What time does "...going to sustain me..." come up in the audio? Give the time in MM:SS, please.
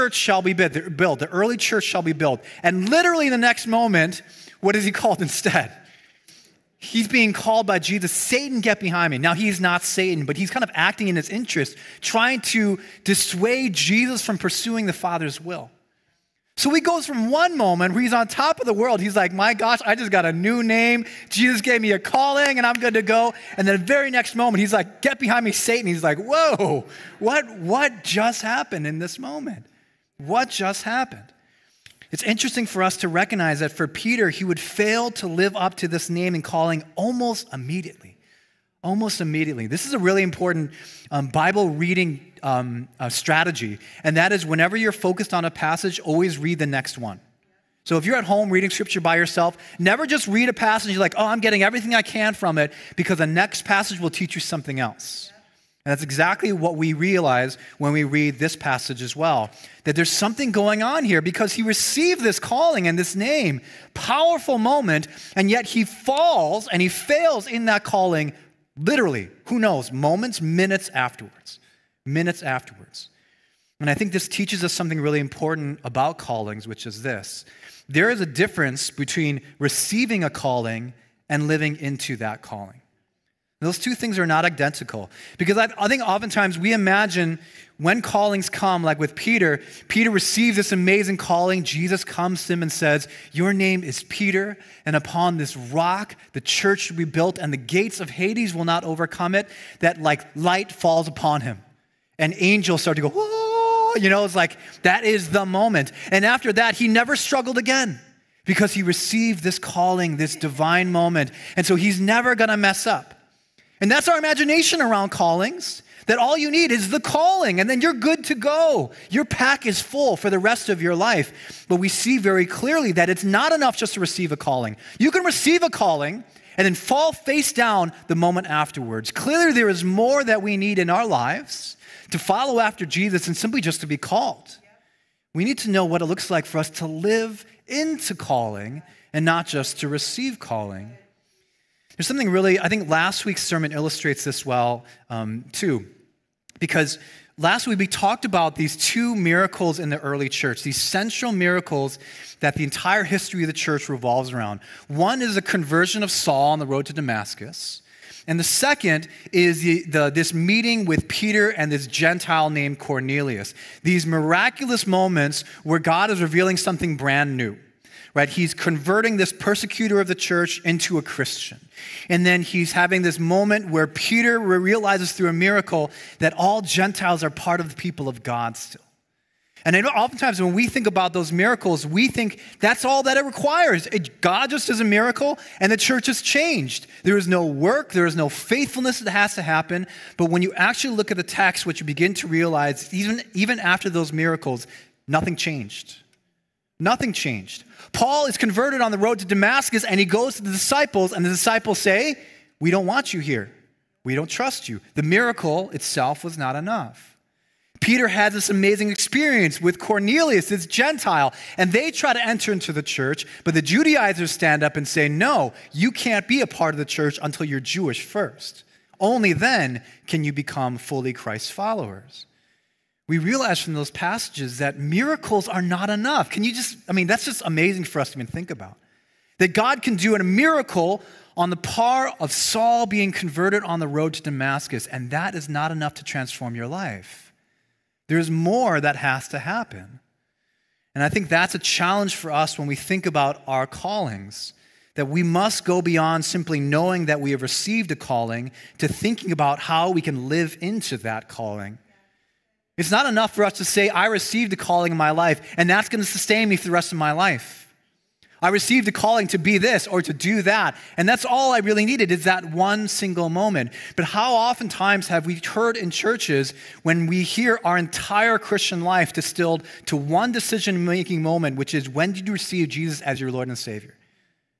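04:15.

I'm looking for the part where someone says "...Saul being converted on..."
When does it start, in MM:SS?
03:52.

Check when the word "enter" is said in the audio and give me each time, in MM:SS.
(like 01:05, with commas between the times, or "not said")
03:32.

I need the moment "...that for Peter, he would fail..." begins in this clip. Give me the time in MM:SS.
00:33.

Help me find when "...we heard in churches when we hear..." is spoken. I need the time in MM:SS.
04:25.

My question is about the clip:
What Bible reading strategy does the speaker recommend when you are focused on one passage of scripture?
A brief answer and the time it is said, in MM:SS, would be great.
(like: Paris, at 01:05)
Always read the next one, at 00:45.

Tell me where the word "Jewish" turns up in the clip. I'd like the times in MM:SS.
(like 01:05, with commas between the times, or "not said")
03:37.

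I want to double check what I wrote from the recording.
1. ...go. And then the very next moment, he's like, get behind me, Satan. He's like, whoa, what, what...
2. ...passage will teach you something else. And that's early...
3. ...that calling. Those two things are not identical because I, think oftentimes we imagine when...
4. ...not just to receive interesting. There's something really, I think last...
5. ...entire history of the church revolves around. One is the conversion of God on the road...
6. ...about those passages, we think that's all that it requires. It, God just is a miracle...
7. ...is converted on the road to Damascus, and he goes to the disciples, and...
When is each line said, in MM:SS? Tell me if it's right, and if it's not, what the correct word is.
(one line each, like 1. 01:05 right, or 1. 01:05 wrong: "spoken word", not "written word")
1. 00:23 right
2. 00:53 wrong: "exactly", not "early"
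3. 01:22 right
4. 02:19 wrong: "calling", not "interesting"
5. 02:32 wrong: "Saul", not "God"
6. 03:00 wrong: "miracles", not "passages"
7. 03:18 right.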